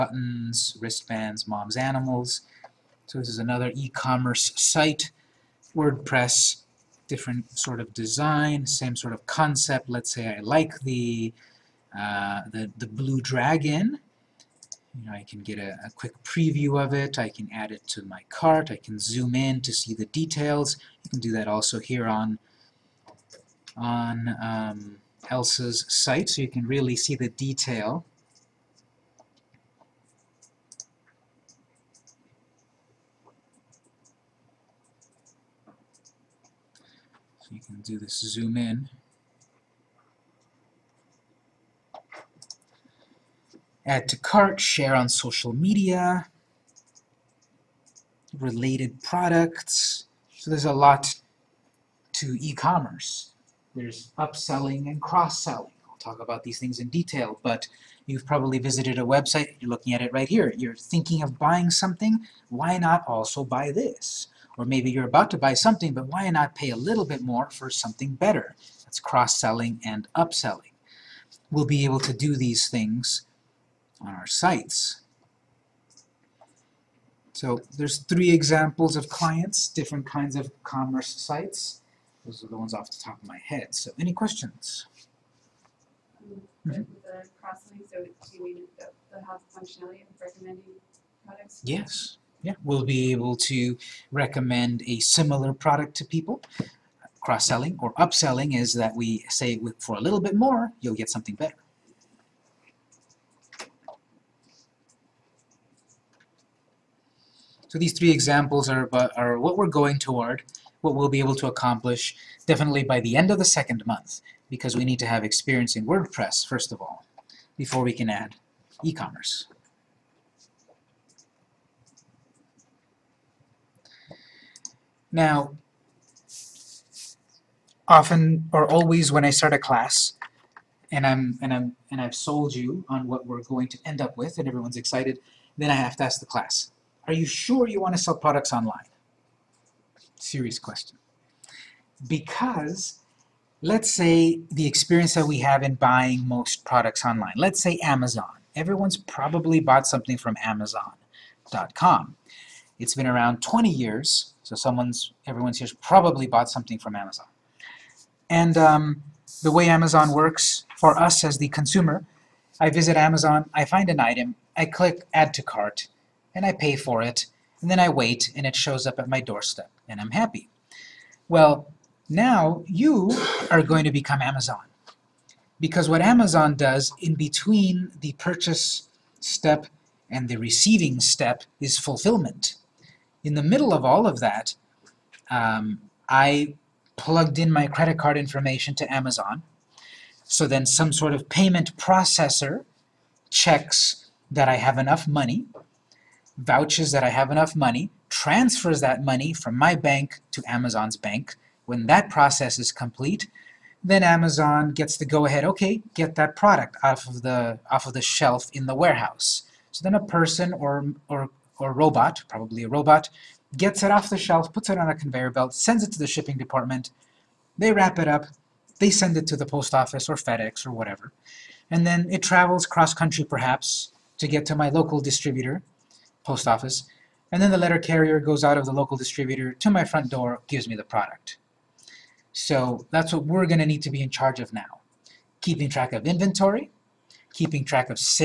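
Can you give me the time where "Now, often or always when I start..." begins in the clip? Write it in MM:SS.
02:05.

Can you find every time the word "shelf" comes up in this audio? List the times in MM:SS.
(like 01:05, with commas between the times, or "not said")
03:28, 03:34.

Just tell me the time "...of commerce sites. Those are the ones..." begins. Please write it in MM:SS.
01:20.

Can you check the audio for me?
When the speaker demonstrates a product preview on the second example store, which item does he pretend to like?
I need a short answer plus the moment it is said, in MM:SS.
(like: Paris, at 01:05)
The blue dragon, at 00:12.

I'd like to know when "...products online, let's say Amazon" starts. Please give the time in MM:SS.
02:26.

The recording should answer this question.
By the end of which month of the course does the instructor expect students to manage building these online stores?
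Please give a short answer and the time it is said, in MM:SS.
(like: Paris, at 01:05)
Second month, at 01:53.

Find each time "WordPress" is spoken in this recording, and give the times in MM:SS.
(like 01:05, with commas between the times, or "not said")
00:05, 01:55.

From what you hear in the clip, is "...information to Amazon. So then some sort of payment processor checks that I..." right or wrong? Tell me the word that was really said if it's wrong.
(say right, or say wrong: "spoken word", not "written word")
right.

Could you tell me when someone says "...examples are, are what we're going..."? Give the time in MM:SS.
01:48.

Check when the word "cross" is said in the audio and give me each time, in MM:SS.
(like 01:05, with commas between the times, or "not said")
00:54, 01:08, 01:37, 03:42.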